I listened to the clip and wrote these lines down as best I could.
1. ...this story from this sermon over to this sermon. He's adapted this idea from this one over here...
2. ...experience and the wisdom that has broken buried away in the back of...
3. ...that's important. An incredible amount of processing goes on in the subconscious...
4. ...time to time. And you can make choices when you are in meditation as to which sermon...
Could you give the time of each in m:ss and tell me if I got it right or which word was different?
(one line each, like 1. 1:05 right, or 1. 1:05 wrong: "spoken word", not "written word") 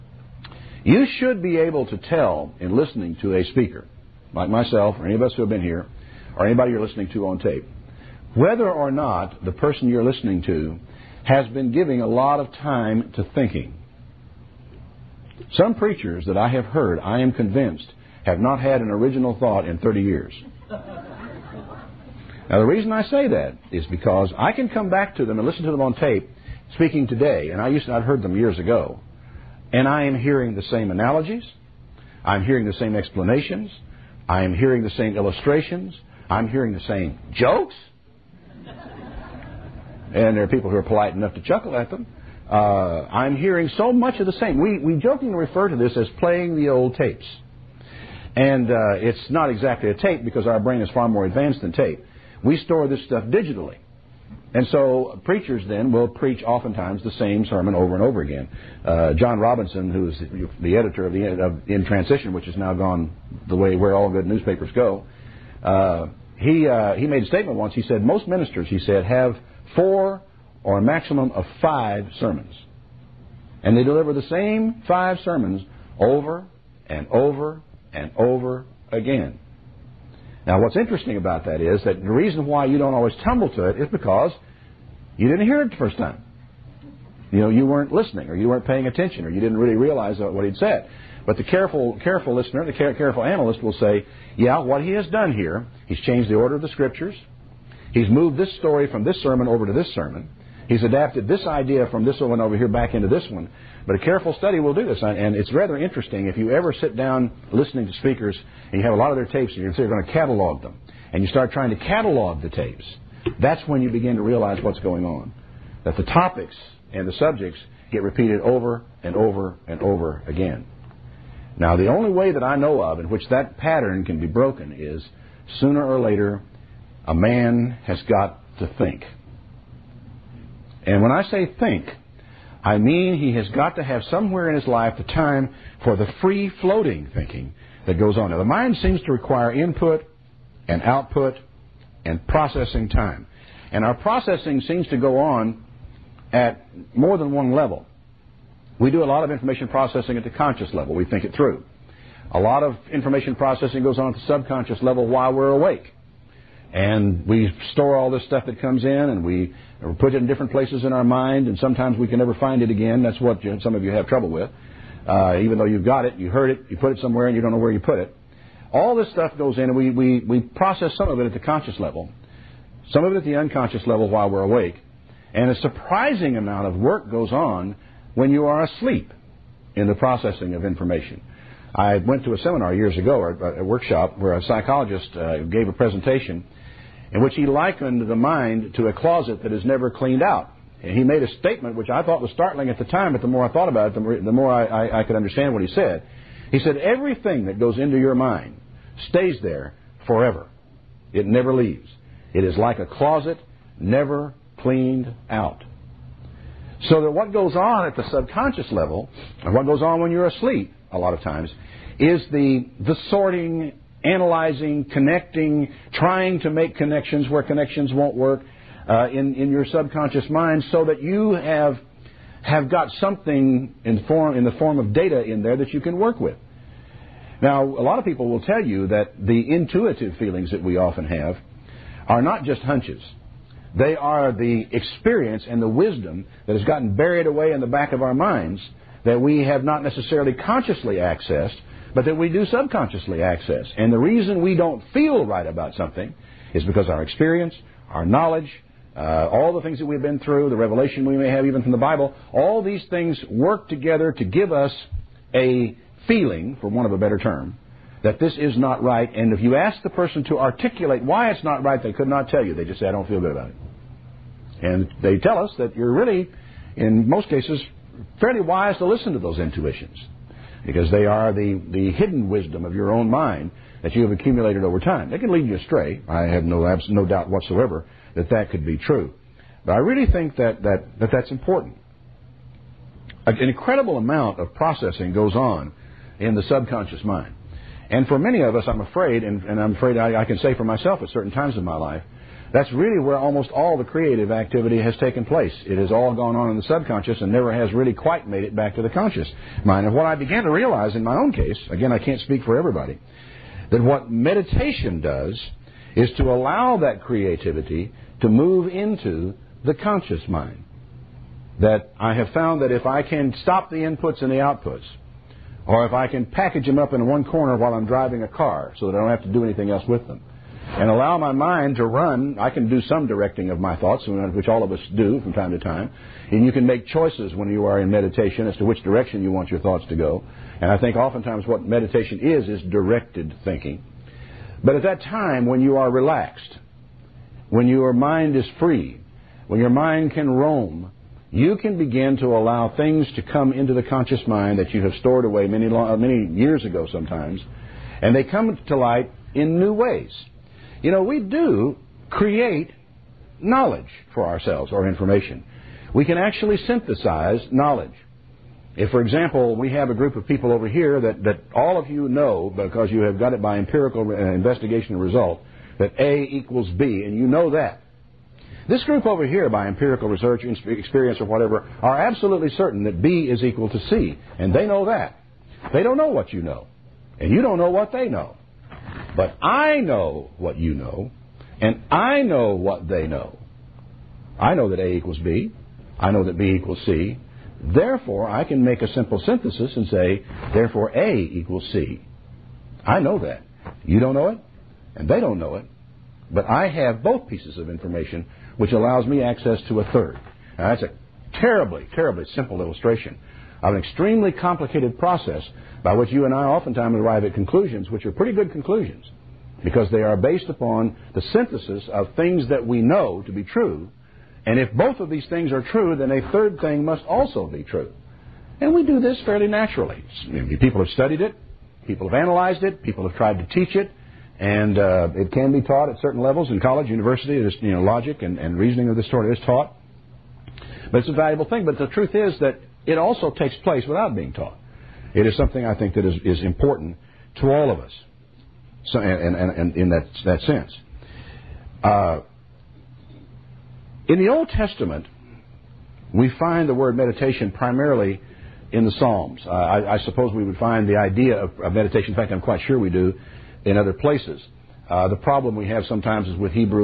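1. 1:38 right
2. 3:54 wrong: "gotten", not "broken"
3. 4:41 right
4. 5:25 wrong: "direction", not "sermon".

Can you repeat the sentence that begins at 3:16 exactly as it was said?
He said, Everything that goes into your mind stays there forever, it never leaves.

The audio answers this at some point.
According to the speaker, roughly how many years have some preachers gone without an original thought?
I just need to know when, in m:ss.
0:19.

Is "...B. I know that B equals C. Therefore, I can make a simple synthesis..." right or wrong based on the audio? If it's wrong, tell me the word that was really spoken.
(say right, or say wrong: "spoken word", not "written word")
right.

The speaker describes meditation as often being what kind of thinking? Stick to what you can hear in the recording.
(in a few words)
Directed thinking.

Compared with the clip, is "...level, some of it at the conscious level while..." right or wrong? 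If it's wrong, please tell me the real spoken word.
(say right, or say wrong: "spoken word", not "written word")
wrong: "unconscious", not "conscious".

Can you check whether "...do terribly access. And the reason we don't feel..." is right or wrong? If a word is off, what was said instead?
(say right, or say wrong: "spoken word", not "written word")
wrong: "subconsciously", not "terribly".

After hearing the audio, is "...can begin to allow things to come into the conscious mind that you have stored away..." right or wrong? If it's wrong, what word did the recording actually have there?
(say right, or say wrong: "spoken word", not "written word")
right.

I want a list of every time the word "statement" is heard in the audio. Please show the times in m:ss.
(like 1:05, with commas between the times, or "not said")
1:07, 3:11.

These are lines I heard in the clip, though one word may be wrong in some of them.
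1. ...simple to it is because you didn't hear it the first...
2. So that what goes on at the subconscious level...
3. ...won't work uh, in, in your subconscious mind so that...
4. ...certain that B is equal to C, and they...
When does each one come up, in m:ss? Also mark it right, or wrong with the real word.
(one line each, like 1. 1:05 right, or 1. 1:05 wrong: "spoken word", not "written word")
1. 1:23 wrong: "tumble", not "simple"
2. 3:26 right
3. 3:37 right
4. 6:12 right.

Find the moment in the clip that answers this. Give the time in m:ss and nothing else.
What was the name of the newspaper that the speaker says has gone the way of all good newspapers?
1:01.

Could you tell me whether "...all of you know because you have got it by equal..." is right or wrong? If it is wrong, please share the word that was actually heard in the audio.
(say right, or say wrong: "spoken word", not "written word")
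wrong: "empirical", not "equal".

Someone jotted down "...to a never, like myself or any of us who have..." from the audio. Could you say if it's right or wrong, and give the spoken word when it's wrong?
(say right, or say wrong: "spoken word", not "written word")
wrong: "speaker", not "never".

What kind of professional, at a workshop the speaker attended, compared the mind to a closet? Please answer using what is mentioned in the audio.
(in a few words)
Psychologist.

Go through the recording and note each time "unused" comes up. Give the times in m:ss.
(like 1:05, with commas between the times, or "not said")
not said.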